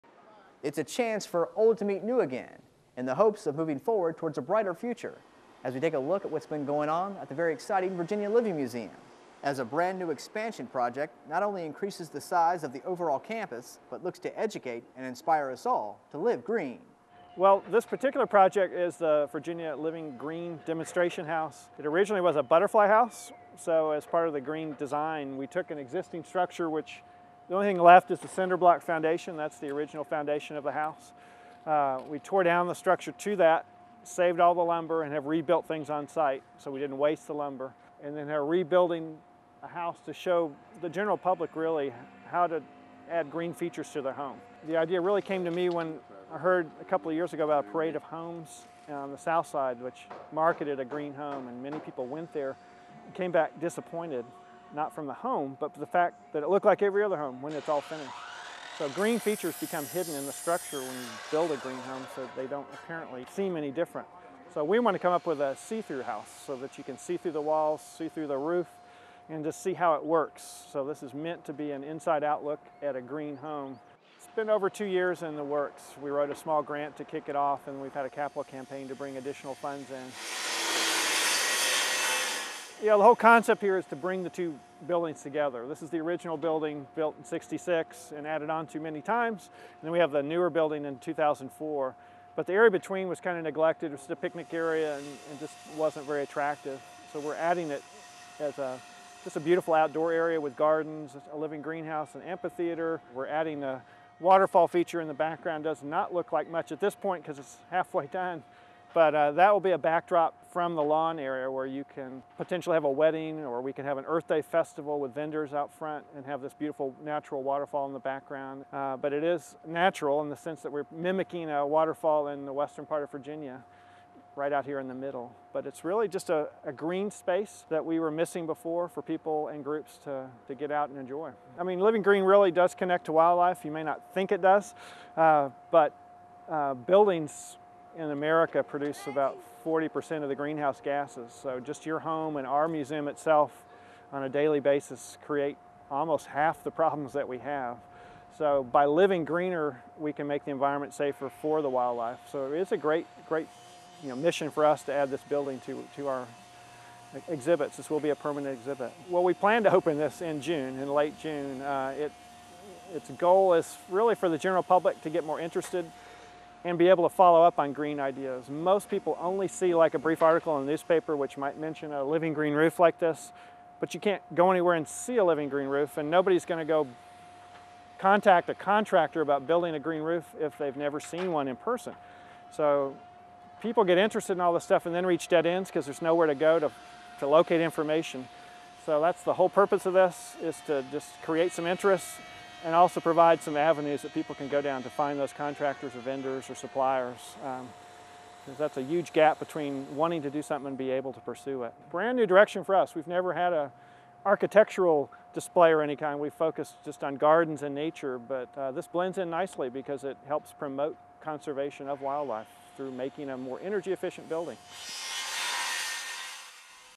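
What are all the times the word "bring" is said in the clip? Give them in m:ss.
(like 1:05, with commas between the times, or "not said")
1:18, 1:23.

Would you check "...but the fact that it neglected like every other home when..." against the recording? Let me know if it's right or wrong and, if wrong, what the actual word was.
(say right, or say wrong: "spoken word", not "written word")
wrong: "looked", not "neglected".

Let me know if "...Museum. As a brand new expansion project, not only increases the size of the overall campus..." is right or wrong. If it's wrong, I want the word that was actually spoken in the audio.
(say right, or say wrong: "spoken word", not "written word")
right.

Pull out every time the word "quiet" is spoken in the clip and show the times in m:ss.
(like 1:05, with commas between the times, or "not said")
not said.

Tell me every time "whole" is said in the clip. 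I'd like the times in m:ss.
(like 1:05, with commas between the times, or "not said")
1:23, 3:09.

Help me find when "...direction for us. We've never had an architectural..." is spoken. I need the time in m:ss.
3:22.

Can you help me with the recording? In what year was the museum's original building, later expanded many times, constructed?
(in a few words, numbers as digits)
1966.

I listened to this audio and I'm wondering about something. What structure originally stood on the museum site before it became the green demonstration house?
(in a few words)
butterfly house.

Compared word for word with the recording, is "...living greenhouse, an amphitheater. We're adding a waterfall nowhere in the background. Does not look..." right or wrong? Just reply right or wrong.
wrong.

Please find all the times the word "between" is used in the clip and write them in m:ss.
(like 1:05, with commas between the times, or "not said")
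1:32, 3:19.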